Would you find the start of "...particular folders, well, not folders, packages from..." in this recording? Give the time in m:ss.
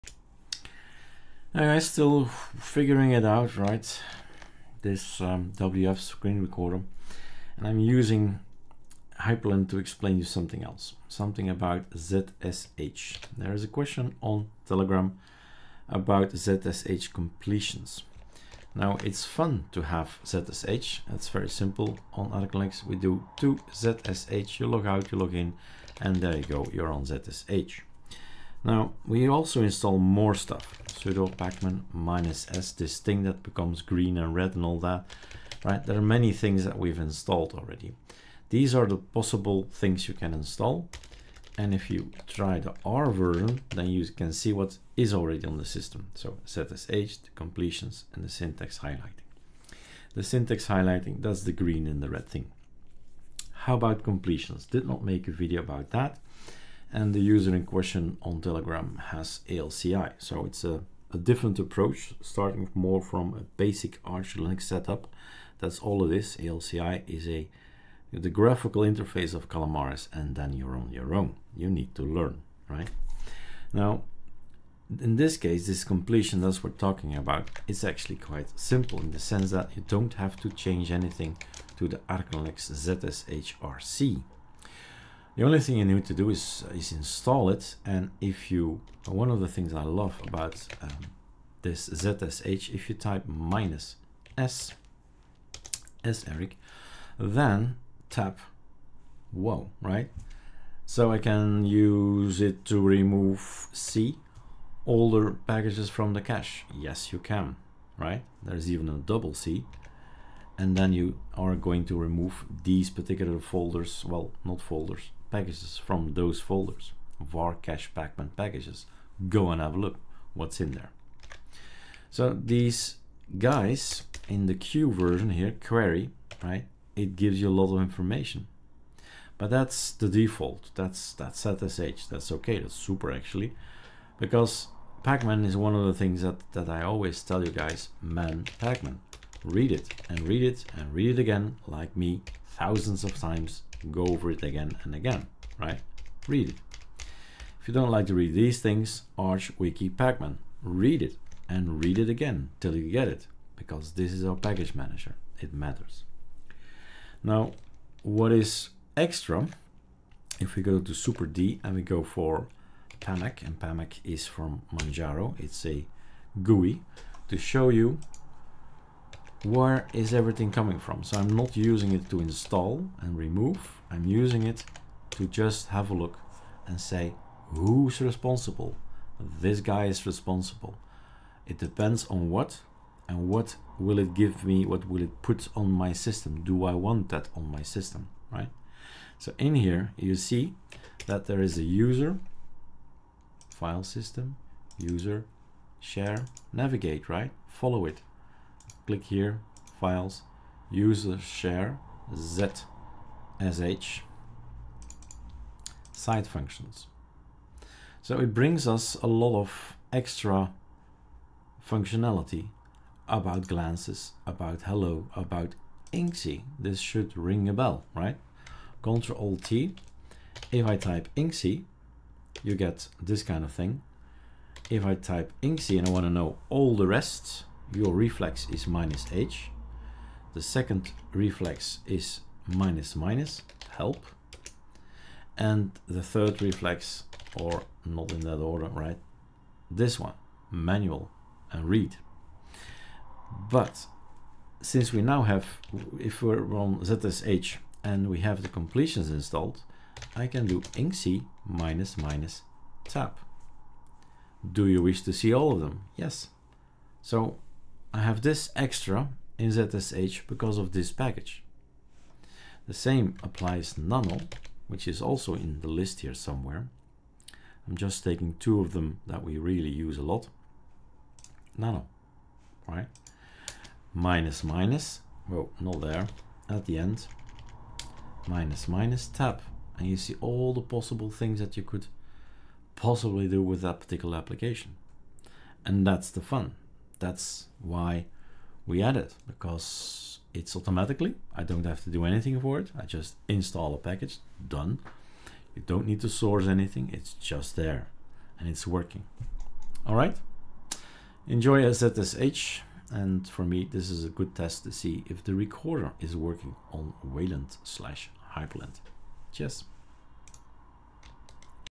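1:52.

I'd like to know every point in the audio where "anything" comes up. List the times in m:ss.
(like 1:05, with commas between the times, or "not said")
1:20, 4:52, 4:56.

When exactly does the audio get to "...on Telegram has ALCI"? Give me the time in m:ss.
0:58.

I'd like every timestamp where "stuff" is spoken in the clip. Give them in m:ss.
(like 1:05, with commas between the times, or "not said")
0:30.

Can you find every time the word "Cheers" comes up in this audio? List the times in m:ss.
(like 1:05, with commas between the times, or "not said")
5:09.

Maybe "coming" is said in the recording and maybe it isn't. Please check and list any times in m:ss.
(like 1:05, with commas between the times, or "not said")
2:50.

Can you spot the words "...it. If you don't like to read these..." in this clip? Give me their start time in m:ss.
2:26.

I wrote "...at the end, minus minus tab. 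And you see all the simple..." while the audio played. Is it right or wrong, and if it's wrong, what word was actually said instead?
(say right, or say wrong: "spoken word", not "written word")
wrong: "possible", not "simple".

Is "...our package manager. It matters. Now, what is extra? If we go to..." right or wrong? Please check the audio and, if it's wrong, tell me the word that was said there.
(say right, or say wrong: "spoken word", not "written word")
right.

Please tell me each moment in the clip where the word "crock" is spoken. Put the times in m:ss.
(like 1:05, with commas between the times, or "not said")
not said.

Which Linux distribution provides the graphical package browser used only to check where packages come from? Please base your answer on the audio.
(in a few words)
Manjaro.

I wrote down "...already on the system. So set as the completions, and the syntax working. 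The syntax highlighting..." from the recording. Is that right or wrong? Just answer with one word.
wrong.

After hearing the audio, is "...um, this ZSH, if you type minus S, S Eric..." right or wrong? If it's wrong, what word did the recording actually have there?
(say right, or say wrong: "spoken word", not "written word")
right.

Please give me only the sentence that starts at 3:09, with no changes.
So in here, you see that there is a user, file system, user, share, navigate, right?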